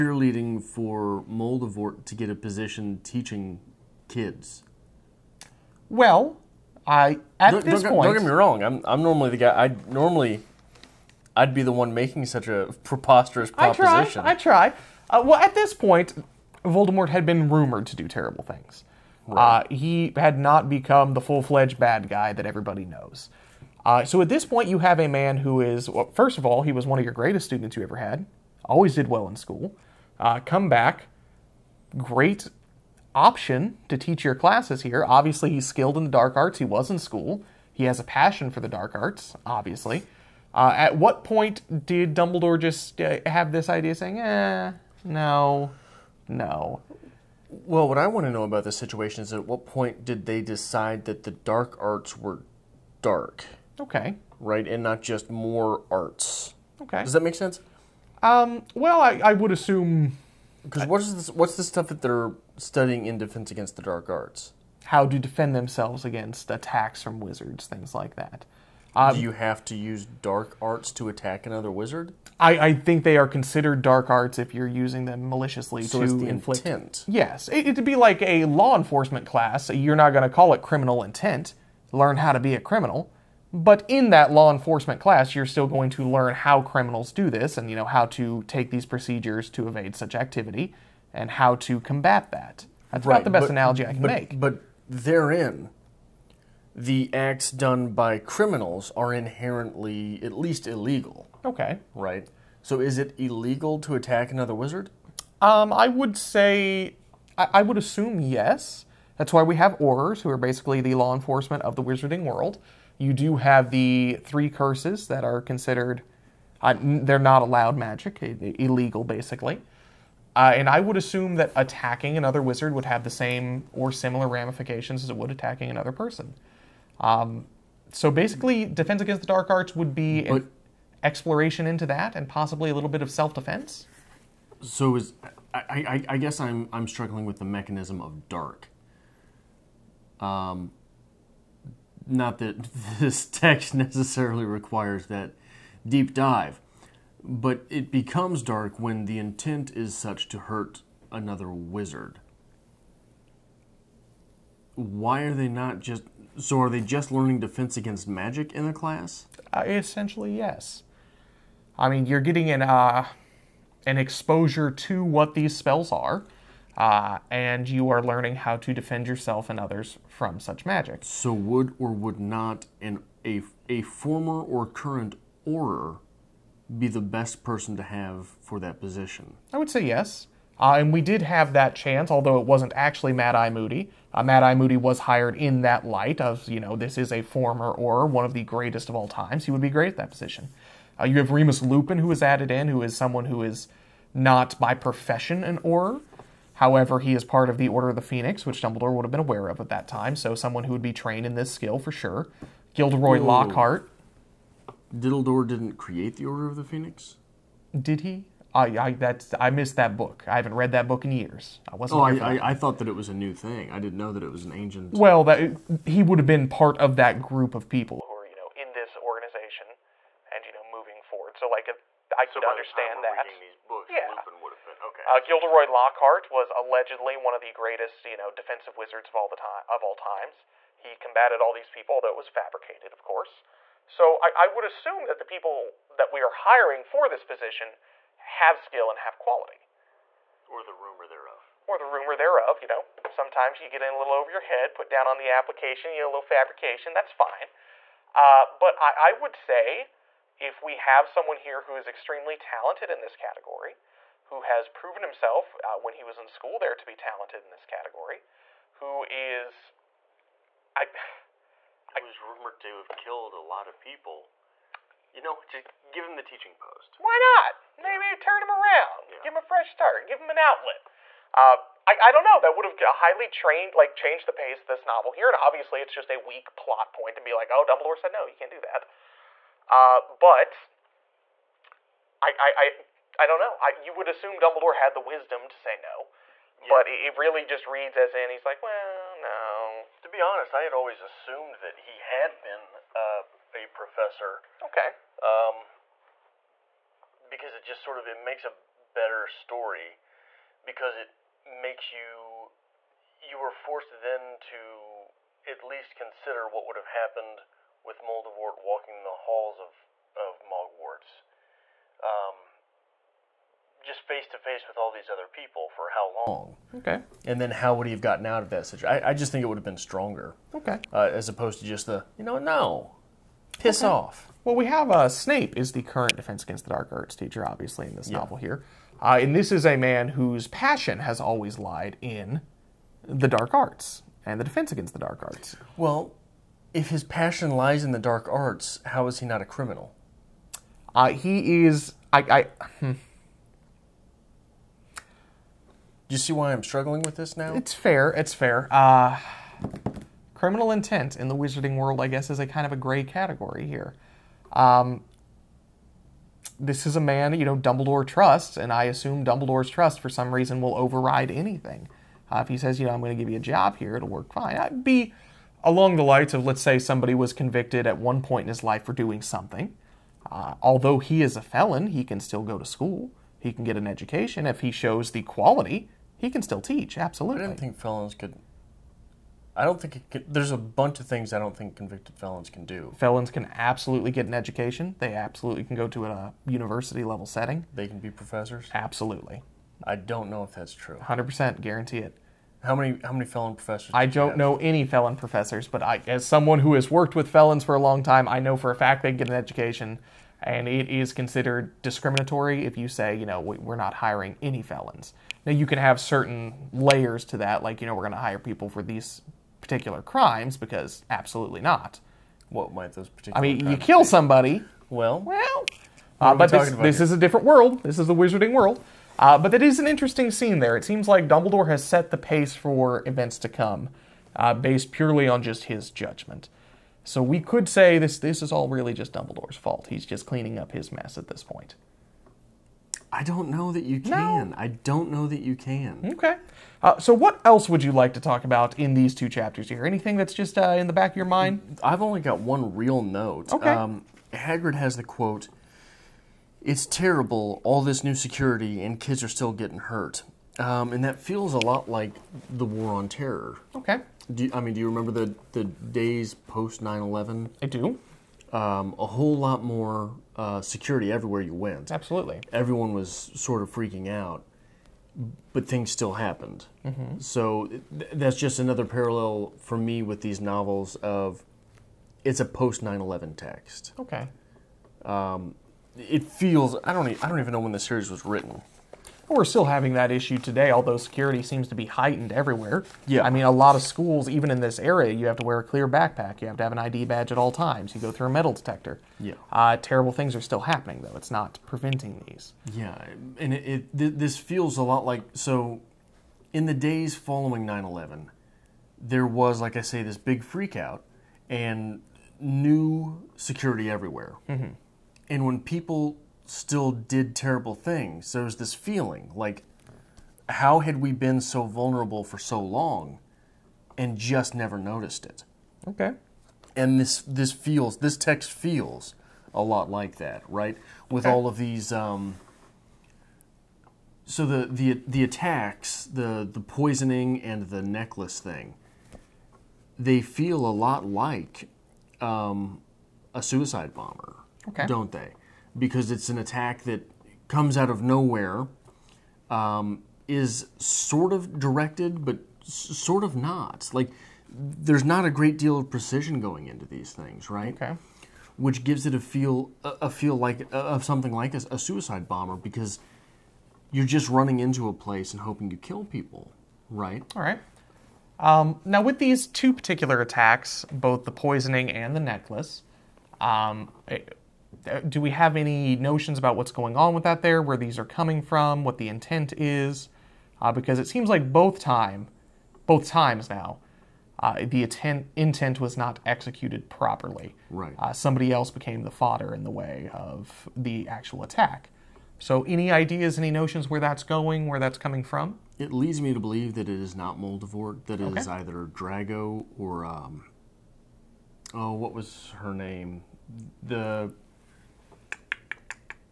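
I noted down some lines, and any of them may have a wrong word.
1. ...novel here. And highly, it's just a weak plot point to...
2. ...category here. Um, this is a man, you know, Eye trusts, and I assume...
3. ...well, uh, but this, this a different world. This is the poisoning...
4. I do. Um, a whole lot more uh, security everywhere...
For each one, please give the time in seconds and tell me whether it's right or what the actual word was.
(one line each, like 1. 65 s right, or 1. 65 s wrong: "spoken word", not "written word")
1. 274 s wrong: "obviously", not "highly"
2. 353 s wrong: "Dumbledore", not "Eye"
3. 415 s wrong: "wizarding", not "poisoning"
4. 457 s right.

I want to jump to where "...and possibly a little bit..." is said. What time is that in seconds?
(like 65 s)
132 s.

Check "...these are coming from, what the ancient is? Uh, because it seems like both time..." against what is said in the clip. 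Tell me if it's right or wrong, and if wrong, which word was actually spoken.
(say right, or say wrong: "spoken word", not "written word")
wrong: "intent", not "ancient".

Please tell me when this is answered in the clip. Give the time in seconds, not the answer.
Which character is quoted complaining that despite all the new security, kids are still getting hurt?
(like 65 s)
444 s.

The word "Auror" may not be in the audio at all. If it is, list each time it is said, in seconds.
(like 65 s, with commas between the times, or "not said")
109 s, 175 s, 195 s.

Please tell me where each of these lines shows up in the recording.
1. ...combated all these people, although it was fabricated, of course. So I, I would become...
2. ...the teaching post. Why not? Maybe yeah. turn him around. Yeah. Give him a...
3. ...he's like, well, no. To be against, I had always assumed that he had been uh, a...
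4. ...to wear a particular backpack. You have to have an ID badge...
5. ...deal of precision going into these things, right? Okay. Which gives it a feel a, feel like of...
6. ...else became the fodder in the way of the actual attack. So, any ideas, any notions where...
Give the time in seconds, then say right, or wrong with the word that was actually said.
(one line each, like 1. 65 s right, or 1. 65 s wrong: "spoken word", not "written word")
1. 230 s wrong: "assume", not "become"
2. 266 s right
3. 288 s wrong: "honest", not "against"
4. 485 s wrong: "clear", not "particular"
5. 545 s right
6. 578 s right.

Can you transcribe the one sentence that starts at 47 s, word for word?
Well, what I want to know about this situation is at what point did they decide that the dark arts were dark?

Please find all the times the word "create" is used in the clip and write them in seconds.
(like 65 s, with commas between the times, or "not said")
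205 s.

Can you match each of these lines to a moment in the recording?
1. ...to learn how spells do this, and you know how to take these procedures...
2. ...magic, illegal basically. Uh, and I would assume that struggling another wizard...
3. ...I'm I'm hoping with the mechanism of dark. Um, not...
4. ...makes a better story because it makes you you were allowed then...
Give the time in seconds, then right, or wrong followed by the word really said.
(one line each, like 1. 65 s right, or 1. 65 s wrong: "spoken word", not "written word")
1. 85 s wrong: "criminals", not "spells"
2. 117 s wrong: "attacking", not "struggling"
3. 136 s wrong: "struggling", not "hoping"
4. 298 s wrong: "forced", not "allowed".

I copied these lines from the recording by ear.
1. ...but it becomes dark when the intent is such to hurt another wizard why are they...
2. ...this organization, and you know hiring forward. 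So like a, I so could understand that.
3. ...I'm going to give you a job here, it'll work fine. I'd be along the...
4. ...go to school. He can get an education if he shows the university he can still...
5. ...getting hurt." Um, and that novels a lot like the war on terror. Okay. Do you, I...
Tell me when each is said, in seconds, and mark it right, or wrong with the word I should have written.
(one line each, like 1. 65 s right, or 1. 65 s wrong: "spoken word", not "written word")
1. 147 s right
2. 218 s wrong: "moving", not "hiring"
3. 362 s right
4. 372 s wrong: "quality", not "university"
5. 449 s wrong: "feels", not "novels".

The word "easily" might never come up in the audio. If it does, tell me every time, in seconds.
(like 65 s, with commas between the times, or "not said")
not said.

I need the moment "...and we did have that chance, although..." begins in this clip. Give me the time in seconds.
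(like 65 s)
180 s.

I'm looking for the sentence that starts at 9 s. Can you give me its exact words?
I normally I'd be the one making such a preposterous proposition.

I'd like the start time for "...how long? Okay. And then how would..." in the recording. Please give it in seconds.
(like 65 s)
315 s.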